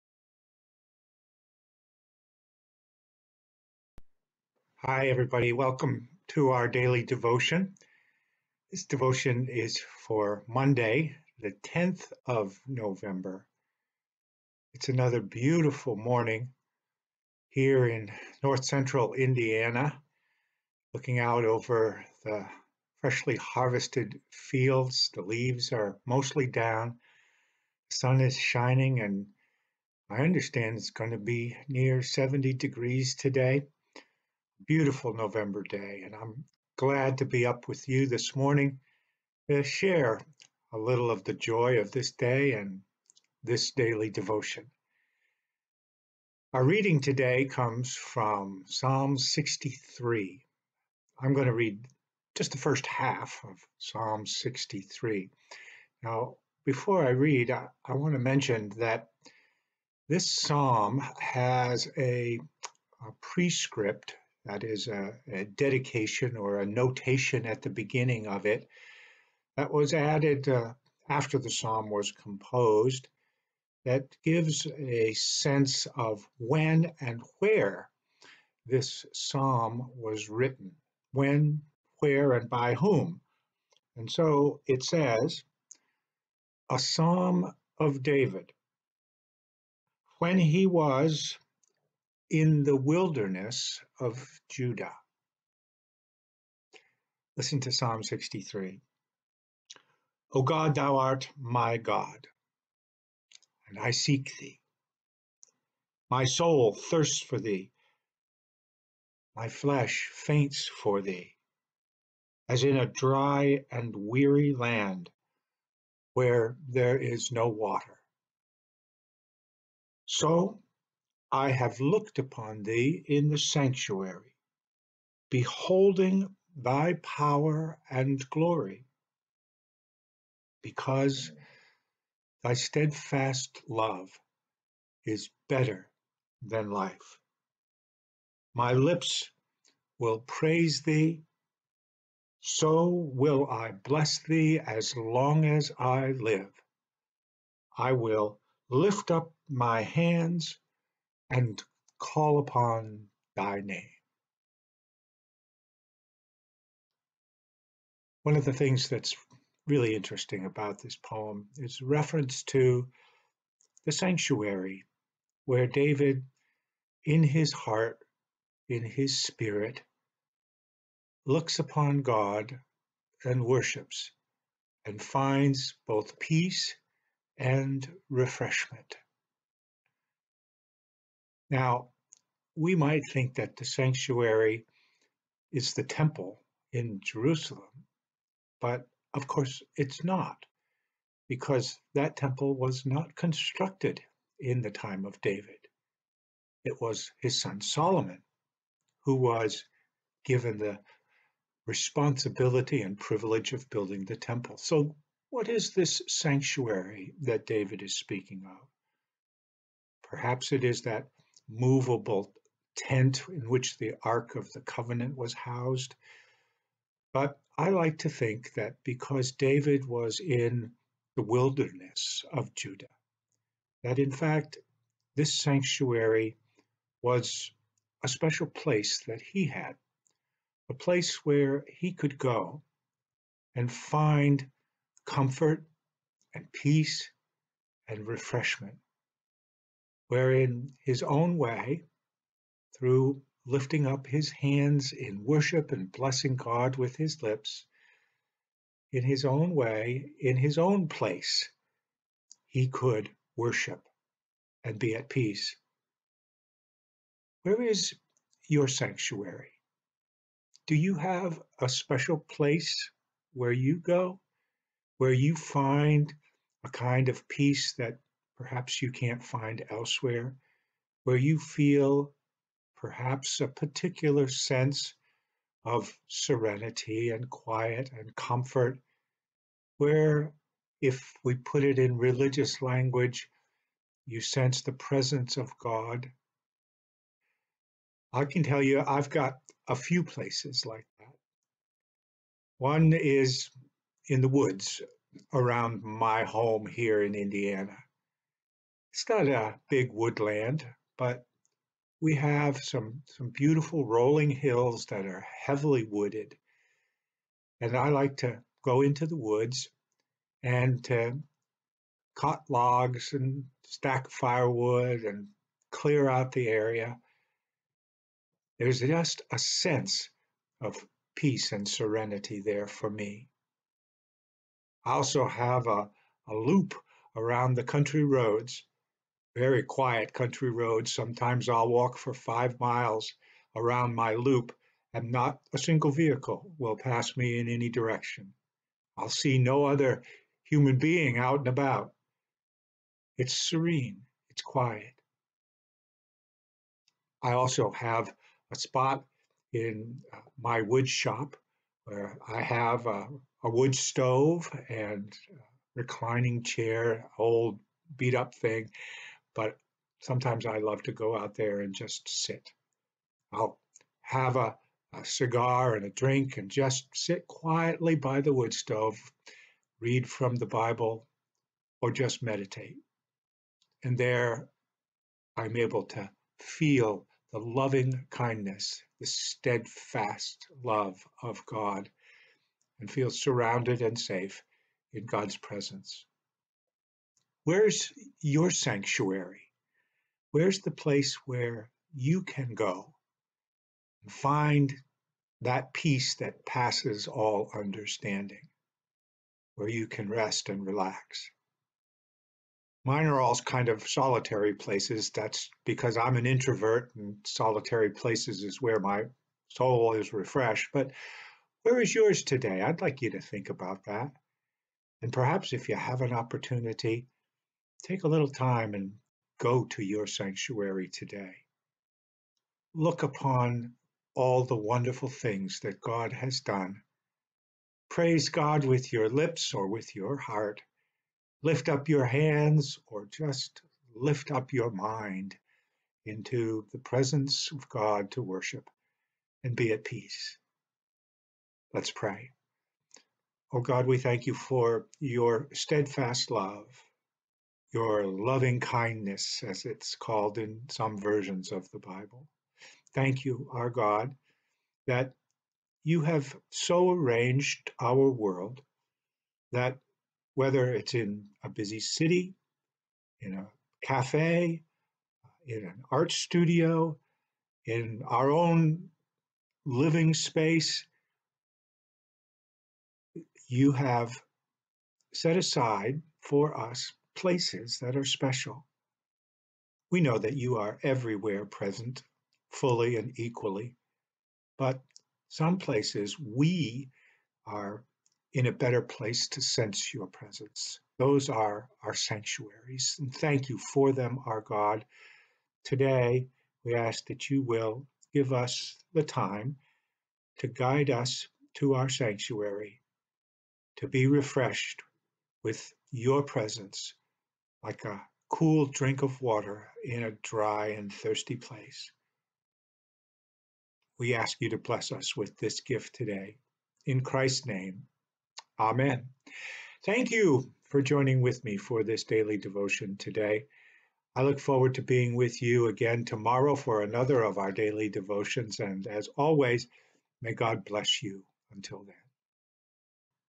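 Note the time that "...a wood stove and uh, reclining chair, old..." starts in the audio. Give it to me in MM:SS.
05:53.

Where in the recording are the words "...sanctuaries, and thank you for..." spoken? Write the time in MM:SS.
08:11.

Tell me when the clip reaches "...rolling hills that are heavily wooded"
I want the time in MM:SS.
05:03.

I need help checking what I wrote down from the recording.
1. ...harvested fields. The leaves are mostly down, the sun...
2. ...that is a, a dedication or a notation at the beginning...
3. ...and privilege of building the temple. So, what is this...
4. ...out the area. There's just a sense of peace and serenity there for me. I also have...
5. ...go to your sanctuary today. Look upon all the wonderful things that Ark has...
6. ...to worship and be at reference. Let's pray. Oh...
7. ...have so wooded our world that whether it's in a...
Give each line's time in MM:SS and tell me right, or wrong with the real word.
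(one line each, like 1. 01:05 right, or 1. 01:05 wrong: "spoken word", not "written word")
1. 00:23 right
2. 01:04 right
3. 03:22 right
4. 05:16 right
5. 06:59 wrong: "God", not "Ark"
6. 07:18 wrong: "peace", not "reference"
7. 07:36 wrong: "arranged", not "wooded".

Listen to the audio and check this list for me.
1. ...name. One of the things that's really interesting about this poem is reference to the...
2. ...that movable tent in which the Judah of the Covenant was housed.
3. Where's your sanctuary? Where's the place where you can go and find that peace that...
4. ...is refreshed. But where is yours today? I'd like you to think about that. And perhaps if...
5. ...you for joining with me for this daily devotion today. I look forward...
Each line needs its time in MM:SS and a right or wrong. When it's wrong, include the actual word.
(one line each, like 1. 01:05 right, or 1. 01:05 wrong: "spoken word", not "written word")
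1. 02:33 right
2. 03:30 wrong: "Ark", not "Judah"
3. 06:27 right
4. 06:49 right
5. 08:40 right.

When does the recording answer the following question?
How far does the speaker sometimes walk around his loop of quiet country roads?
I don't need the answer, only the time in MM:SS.
05:32.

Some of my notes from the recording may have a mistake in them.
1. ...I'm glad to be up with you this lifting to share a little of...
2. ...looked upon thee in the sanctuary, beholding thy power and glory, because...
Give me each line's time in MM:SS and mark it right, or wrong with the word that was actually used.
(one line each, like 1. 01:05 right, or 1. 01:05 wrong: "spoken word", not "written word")
1. 00:36 wrong: "morning", not "lifting"
2. 02:01 right.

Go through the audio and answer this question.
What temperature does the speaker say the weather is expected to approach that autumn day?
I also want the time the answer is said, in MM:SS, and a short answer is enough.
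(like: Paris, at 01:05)
70 degrees, at 00:32.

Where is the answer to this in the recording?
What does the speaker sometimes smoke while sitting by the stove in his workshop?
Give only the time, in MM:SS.
06:05.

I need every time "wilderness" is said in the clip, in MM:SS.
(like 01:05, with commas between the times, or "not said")
01:32, 03:41.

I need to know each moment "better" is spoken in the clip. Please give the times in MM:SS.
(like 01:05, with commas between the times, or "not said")
02:15, 08:08.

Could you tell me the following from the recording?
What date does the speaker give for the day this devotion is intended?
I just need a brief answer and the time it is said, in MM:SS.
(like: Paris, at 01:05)
Monday, November 10, at 00:10.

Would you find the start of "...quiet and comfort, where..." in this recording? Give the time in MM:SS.
04:37.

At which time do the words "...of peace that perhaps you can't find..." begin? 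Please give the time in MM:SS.
04:27.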